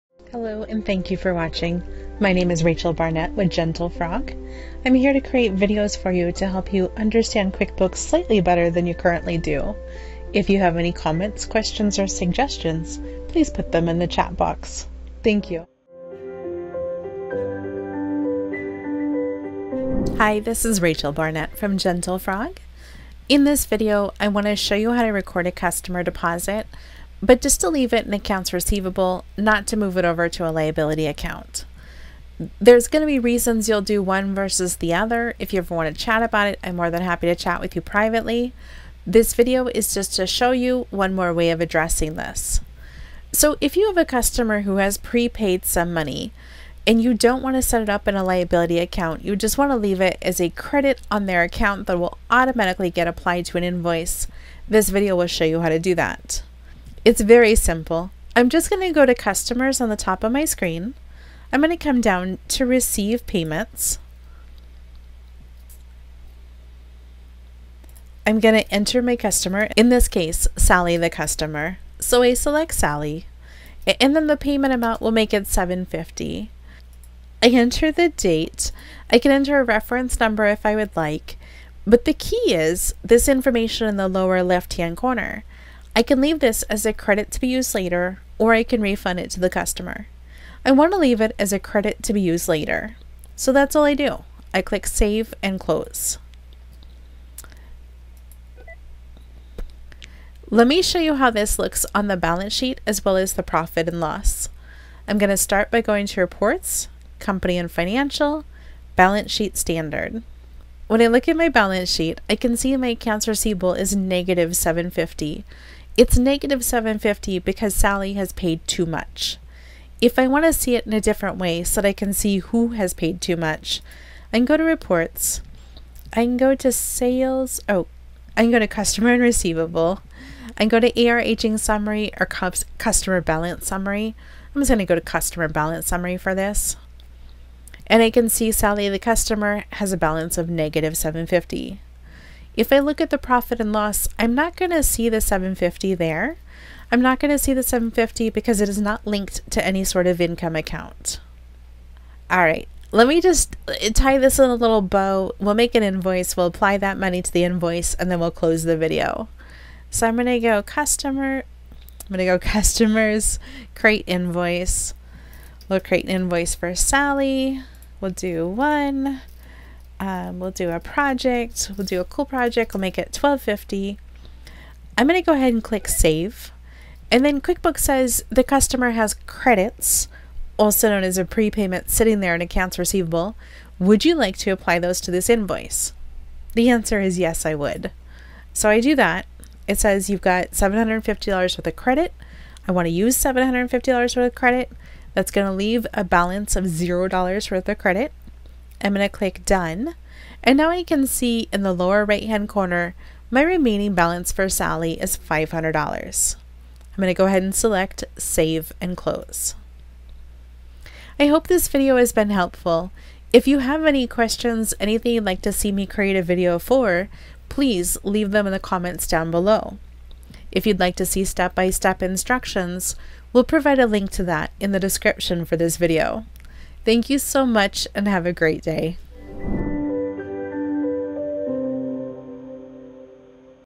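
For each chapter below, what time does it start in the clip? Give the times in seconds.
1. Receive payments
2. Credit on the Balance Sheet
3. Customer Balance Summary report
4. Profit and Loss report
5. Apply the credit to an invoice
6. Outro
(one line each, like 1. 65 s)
1. 42 s
2. 100 s
3. 120 s
4. 142 s
5. 153 s
6. 210 s.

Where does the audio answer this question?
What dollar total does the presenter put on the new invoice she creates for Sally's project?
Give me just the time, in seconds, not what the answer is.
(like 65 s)
173 s.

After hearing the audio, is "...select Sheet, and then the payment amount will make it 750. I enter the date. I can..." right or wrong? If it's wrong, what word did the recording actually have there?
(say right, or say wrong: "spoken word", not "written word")
wrong: "Sally", not "Sheet".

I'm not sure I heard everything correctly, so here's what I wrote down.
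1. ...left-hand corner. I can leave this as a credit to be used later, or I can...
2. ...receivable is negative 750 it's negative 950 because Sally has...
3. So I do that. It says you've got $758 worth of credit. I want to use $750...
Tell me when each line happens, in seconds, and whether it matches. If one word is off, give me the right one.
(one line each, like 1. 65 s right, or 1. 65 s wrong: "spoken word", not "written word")
1. 84 s right
2. 113 s wrong: "750", not "950"
3. 188 s wrong: "750", not "758".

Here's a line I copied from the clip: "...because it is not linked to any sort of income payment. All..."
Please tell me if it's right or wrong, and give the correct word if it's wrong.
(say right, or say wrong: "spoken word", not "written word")
wrong: "account", not "payment".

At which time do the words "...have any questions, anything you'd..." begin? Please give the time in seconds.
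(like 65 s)
213 s.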